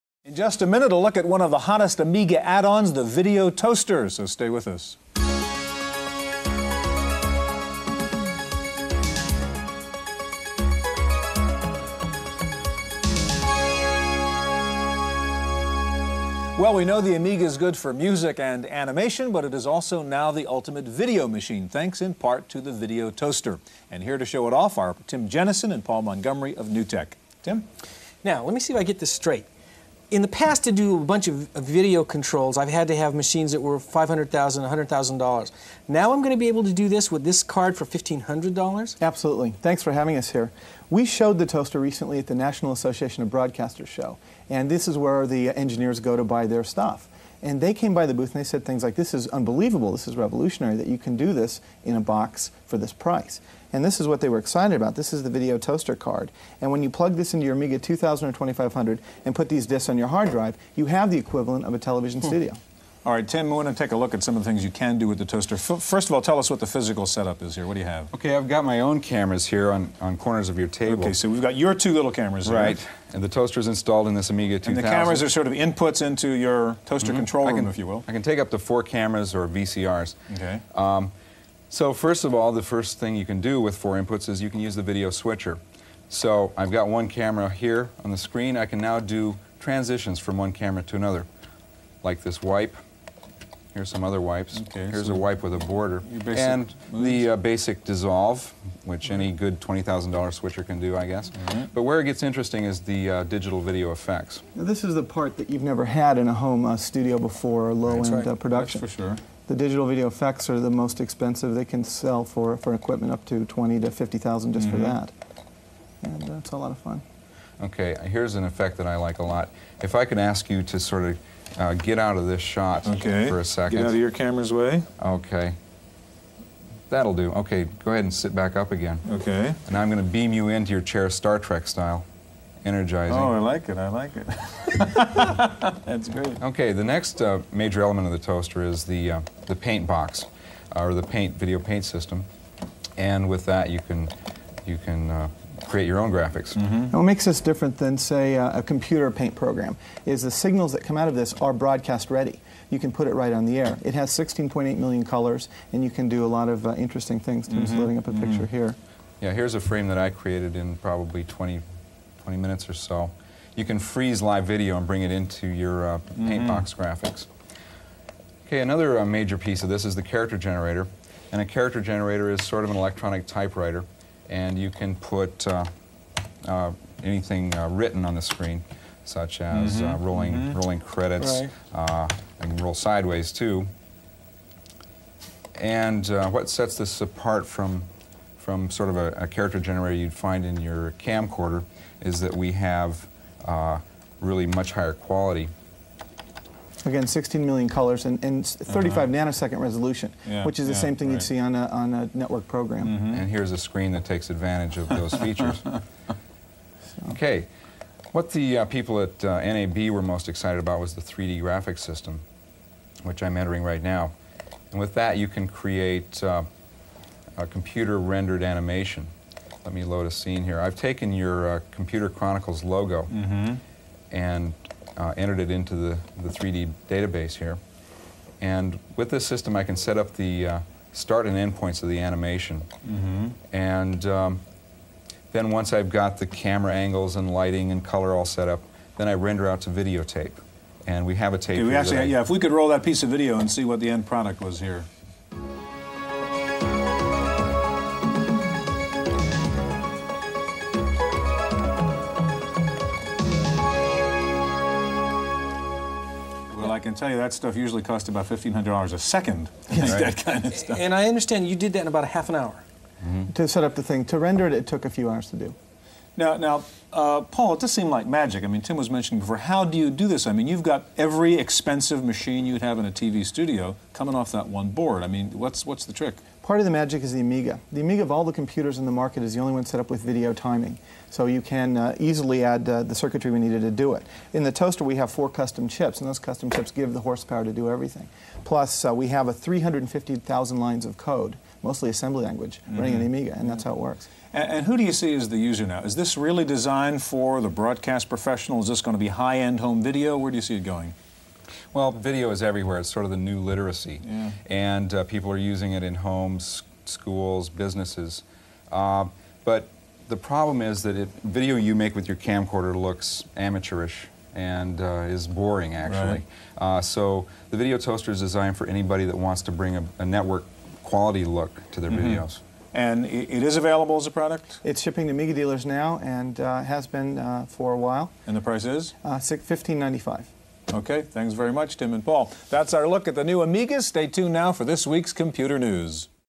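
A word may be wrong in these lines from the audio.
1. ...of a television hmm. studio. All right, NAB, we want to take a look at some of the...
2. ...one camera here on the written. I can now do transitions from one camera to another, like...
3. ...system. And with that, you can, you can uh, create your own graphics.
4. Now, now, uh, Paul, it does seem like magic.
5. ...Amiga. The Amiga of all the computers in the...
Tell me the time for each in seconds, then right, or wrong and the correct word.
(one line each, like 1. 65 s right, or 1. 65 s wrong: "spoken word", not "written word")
1. 61 s wrong: "Tim", not "NAB"
2. 86 s wrong: "screen", not "written"
3. 141 s right
4. 266 s right
5. 277 s right.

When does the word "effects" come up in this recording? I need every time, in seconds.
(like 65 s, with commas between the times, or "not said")
103 s, 110 s, 118 s.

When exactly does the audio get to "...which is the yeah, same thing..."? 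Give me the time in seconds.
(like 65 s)
200 s.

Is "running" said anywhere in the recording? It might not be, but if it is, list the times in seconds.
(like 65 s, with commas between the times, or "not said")
292 s.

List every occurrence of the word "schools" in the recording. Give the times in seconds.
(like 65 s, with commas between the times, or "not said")
306 s.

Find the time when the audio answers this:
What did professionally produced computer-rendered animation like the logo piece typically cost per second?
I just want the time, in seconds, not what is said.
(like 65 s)
258 s.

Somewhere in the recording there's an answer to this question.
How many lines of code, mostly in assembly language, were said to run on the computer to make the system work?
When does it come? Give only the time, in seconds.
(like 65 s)
289 s.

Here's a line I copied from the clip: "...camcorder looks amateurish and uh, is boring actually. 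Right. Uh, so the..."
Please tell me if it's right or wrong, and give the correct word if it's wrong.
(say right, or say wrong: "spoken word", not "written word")
right.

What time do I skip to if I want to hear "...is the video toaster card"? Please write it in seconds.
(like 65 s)
55 s.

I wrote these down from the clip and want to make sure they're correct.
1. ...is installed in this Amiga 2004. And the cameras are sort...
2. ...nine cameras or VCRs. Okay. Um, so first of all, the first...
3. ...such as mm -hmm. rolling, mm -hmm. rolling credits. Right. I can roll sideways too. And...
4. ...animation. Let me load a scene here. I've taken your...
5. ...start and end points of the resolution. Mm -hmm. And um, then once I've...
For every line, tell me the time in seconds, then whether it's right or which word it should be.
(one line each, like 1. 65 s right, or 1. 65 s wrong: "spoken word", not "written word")
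1. 73 s wrong: "2000", not "2004"
2. 78 s wrong: "four", not "nine"
3. 179 s right
4. 218 s right
5. 230 s wrong: "animation", not "resolution".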